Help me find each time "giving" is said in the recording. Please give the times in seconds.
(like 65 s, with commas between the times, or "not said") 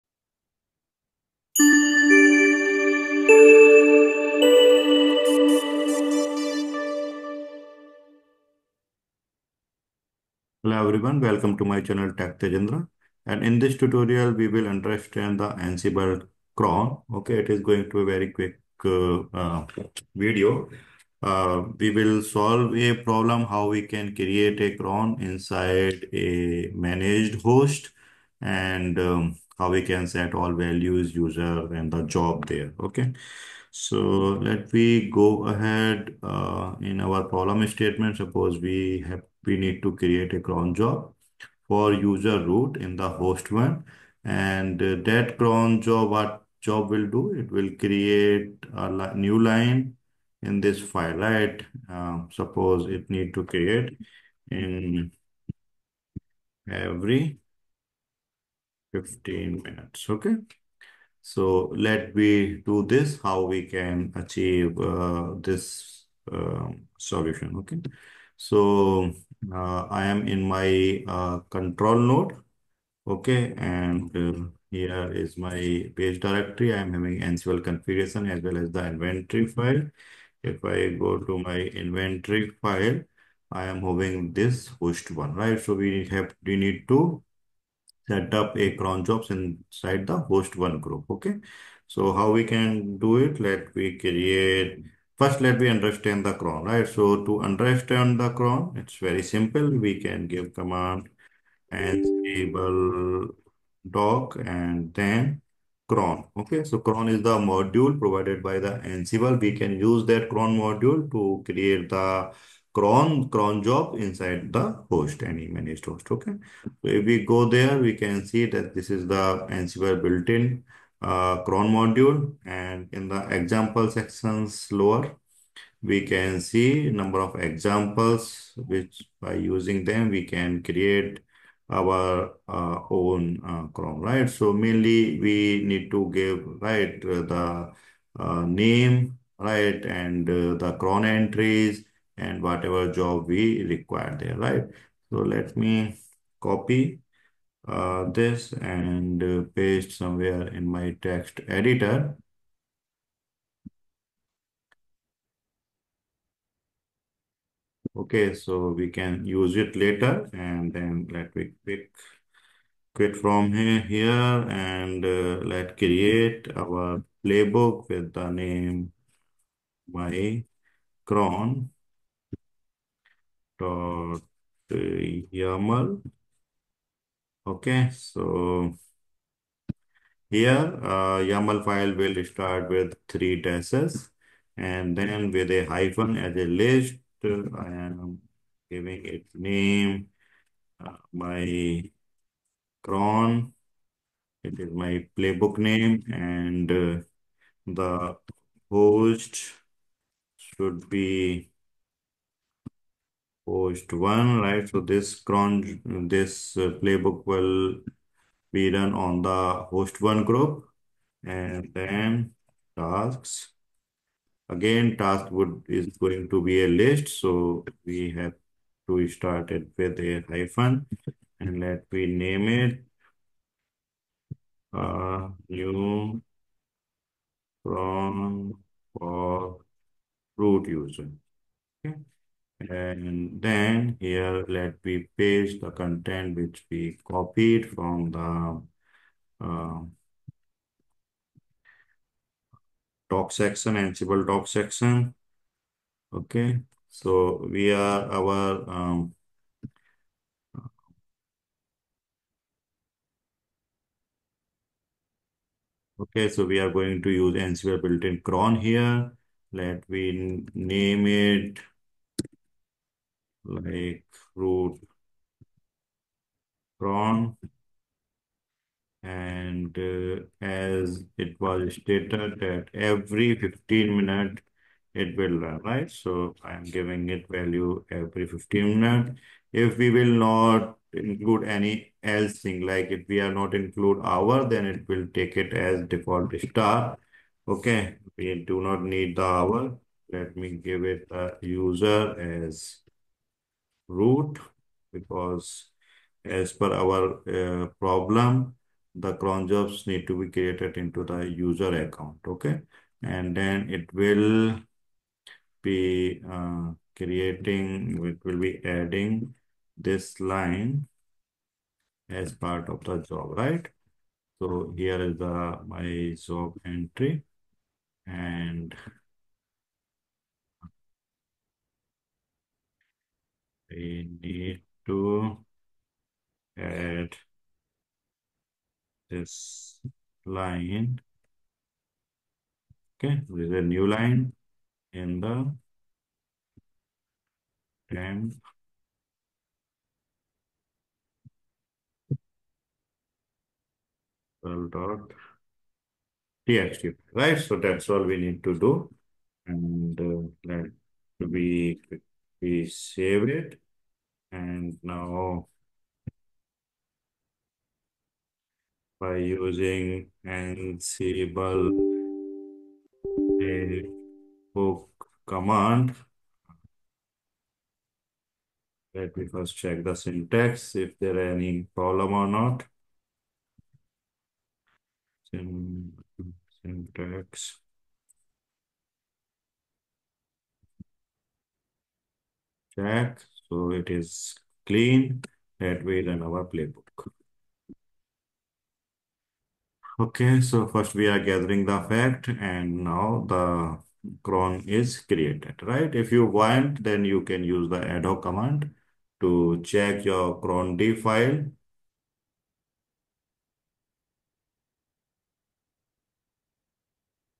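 188 s, 276 s.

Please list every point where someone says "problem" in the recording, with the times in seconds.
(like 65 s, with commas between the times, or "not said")
23 s, 37 s, 297 s, 371 s.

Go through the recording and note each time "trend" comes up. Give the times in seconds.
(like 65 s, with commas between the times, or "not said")
not said.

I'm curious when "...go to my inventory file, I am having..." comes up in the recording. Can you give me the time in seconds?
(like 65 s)
81 s.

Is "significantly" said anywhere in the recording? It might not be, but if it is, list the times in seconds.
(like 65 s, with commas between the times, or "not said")
not said.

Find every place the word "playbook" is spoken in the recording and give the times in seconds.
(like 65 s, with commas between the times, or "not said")
167 s, 195 s, 206 s, 386 s.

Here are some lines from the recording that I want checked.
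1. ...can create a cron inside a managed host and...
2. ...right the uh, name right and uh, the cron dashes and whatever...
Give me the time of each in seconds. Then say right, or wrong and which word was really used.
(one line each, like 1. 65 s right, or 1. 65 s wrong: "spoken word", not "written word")
1. 23 s right
2. 136 s wrong: "entries", not "dashes".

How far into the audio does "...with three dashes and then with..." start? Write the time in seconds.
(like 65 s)
182 s.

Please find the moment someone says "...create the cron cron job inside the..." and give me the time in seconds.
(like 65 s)
111 s.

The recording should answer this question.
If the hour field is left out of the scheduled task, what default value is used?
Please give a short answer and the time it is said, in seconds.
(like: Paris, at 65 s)
star, at 286 s.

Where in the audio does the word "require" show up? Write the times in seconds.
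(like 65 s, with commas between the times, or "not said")
143 s.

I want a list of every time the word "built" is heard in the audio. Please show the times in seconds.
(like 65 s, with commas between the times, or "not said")
120 s, 257 s.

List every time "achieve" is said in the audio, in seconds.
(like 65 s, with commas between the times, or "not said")
64 s.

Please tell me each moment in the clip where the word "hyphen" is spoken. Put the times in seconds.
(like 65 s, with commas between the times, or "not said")
185 s, 220 s.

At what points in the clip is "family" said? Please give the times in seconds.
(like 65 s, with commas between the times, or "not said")
not said.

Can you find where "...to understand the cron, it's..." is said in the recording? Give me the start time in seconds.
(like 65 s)
97 s.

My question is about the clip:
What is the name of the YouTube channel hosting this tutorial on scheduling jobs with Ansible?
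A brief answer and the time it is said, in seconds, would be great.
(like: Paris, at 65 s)
Tech Tejendra, at 12 s.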